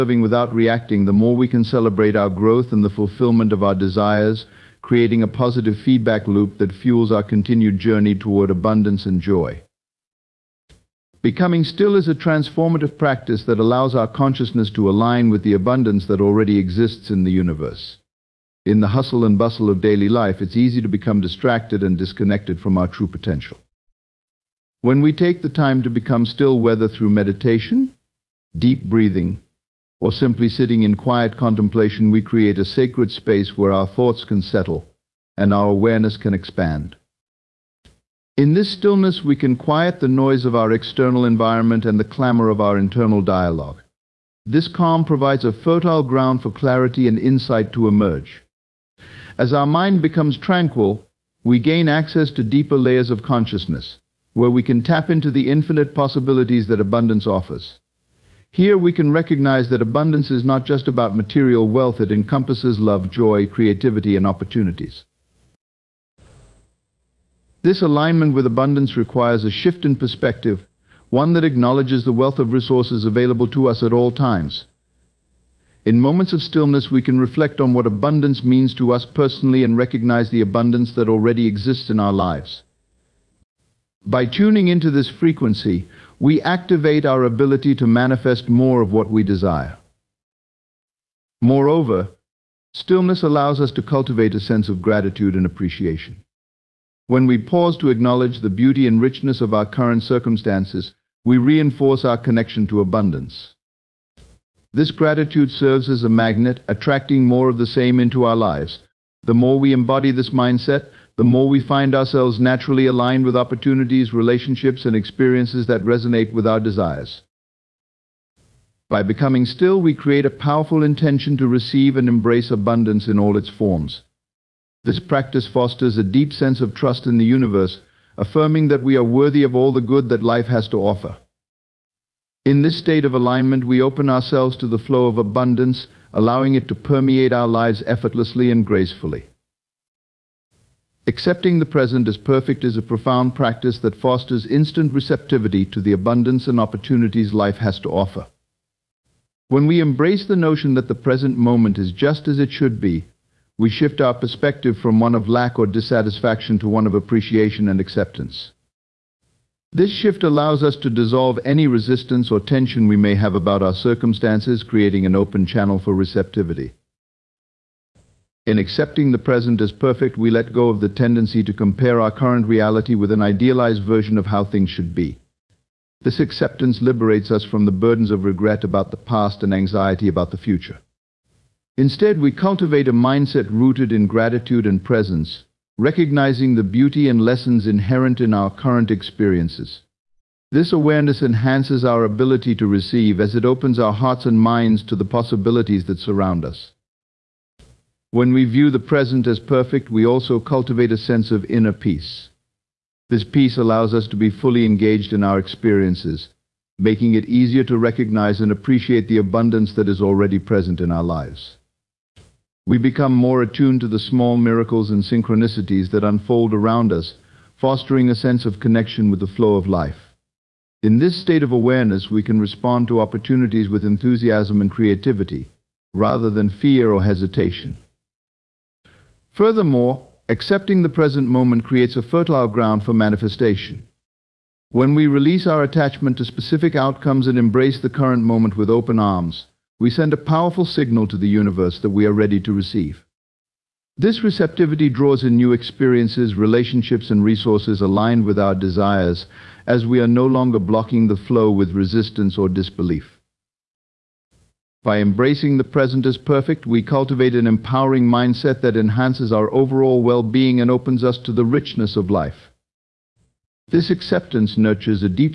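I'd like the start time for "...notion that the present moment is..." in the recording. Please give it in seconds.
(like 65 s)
150 s.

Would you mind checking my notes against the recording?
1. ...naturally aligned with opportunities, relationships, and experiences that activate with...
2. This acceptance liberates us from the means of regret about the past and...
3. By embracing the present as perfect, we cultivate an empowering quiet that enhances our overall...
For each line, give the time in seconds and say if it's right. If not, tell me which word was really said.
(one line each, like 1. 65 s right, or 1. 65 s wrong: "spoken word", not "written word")
1. 112 s wrong: "resonate", not "activate"
2. 176 s wrong: "burdens", not "means"
3. 254 s wrong: "mindset", not "quiet".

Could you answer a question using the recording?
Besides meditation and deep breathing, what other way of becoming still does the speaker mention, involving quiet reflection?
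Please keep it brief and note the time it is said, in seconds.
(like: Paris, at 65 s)
quiet contemplation, at 30 s.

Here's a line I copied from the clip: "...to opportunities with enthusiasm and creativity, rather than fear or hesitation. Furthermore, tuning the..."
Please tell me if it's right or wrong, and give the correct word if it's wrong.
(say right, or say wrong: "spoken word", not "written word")
wrong: "accepting", not "tuning".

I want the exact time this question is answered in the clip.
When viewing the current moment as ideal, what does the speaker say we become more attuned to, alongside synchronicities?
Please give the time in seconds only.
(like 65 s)
213 s.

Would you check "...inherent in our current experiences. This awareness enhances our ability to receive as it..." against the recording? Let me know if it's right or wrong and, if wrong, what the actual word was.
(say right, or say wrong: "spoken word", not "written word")
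right.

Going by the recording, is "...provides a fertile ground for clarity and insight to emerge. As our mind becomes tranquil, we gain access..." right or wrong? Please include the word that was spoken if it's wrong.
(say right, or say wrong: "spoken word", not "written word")
right.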